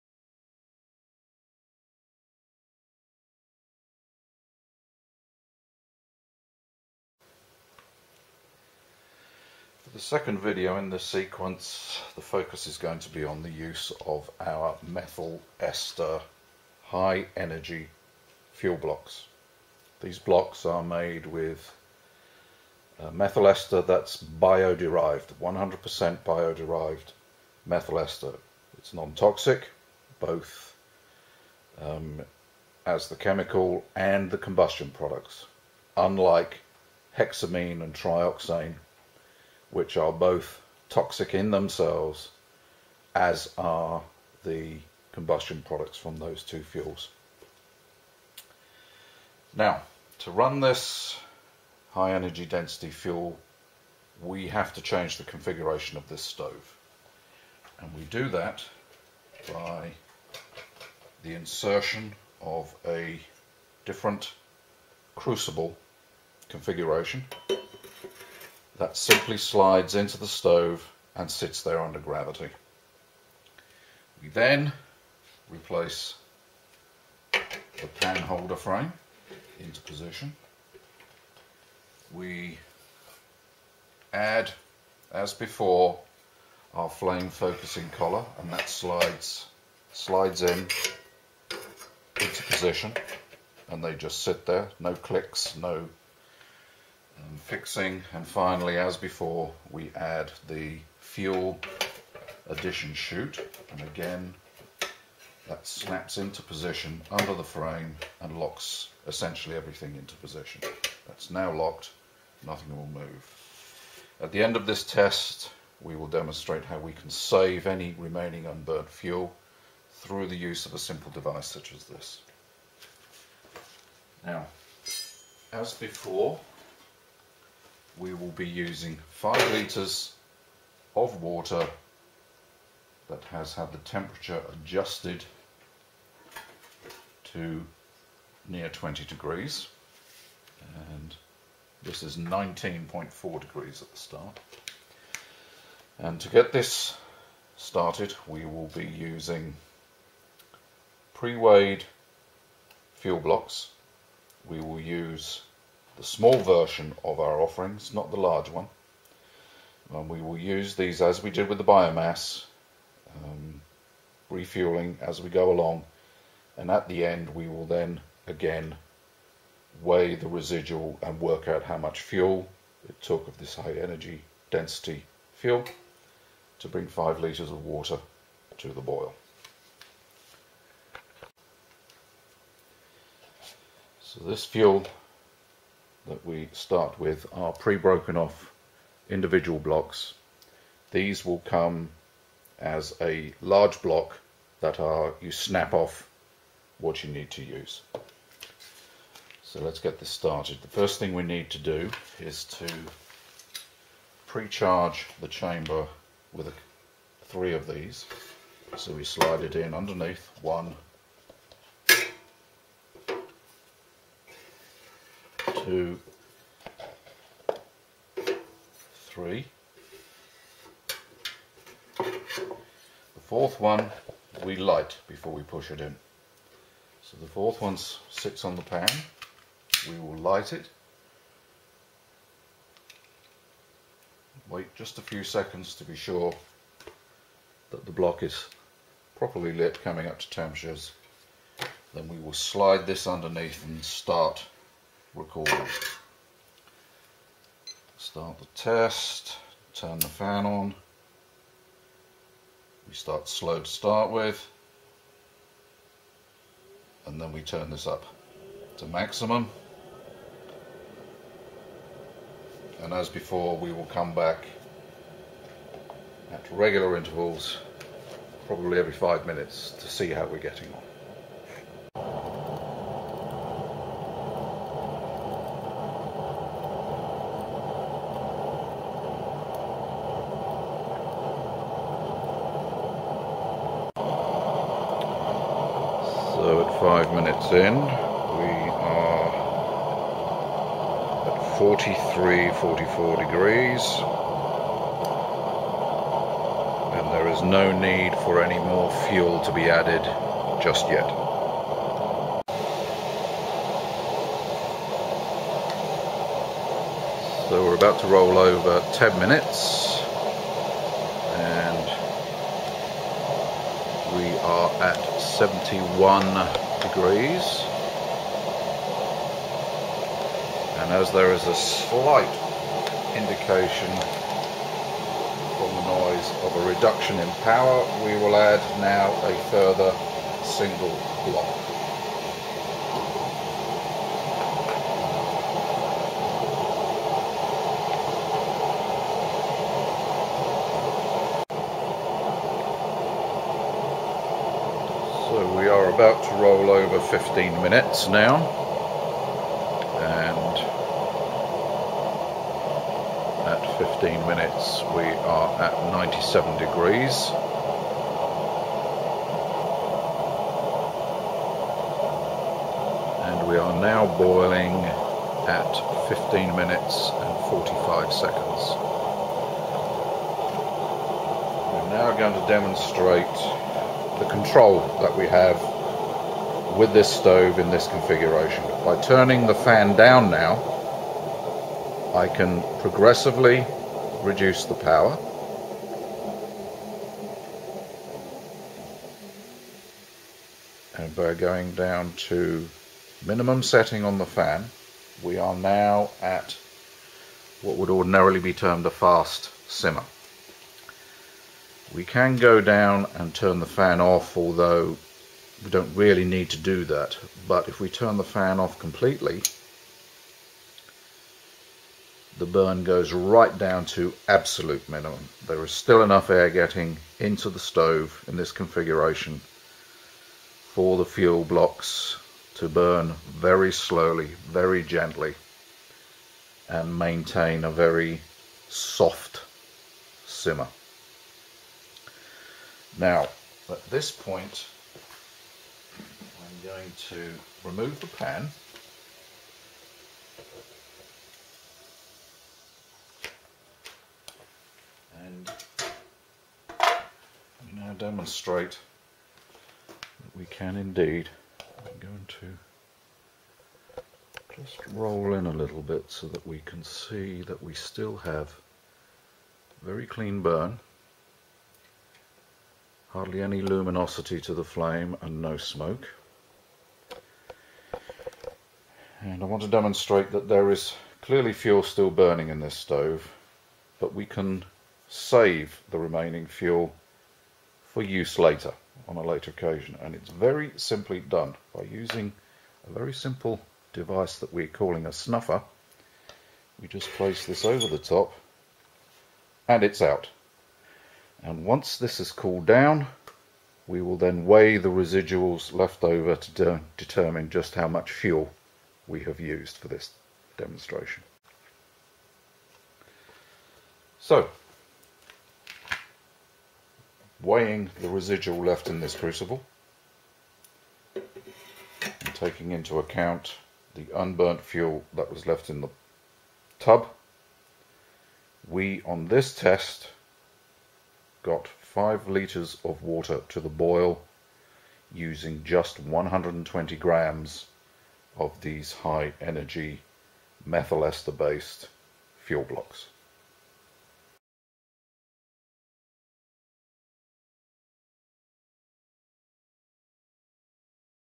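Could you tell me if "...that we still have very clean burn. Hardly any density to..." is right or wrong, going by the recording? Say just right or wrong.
wrong.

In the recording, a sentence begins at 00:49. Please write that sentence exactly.
Now, to run this high energy density fuel, we have to change the configuration of this stove.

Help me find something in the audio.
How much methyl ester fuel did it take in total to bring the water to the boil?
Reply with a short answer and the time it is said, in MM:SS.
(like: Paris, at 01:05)
120 grams, at 08:45.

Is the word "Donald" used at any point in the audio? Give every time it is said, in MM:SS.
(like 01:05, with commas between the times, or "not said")
not said.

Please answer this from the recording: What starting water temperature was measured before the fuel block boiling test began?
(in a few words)
19.4 degrees.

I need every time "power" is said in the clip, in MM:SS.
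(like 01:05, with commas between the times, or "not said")
05:27, 06:24.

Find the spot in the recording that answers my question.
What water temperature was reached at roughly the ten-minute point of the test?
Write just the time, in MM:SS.
05:15.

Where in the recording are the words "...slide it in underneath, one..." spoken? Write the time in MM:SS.
03:29.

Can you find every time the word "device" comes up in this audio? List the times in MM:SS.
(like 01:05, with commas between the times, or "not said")
02:01, 08:03.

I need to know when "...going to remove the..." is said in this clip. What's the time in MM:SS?
07:16.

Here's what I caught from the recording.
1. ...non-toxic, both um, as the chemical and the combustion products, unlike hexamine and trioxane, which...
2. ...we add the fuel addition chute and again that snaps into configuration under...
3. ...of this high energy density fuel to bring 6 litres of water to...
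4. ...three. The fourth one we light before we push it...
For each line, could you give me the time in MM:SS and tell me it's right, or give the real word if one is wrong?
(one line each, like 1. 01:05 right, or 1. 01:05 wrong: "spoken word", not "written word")
1. 00:28 right
2. 01:39 wrong: "position", not "configuration"
3. 02:53 wrong: "5", not "6"
4. 03:39 right.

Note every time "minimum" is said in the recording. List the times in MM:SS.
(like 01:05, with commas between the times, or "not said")
06:33, 06:54.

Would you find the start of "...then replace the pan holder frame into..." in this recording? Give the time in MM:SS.
01:14.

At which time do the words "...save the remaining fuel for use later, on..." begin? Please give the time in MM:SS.
07:55.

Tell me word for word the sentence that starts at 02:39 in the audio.
And we will use these as we did with the biomass, um, refueling as we go along.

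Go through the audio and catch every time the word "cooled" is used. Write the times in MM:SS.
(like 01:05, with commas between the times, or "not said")
08:12.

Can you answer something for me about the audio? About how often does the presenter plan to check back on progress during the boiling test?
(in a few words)
every 5 minutes.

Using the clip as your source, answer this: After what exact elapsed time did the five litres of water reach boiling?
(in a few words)
15 minutes 45 seconds.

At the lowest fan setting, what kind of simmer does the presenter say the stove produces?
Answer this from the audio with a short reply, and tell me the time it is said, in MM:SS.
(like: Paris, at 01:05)
fast simmer, at 06:38.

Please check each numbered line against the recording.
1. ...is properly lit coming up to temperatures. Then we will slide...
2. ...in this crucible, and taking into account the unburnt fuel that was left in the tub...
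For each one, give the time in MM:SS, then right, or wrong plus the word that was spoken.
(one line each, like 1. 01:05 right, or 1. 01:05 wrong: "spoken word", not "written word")
1. 03:58 right
2. 08:28 right.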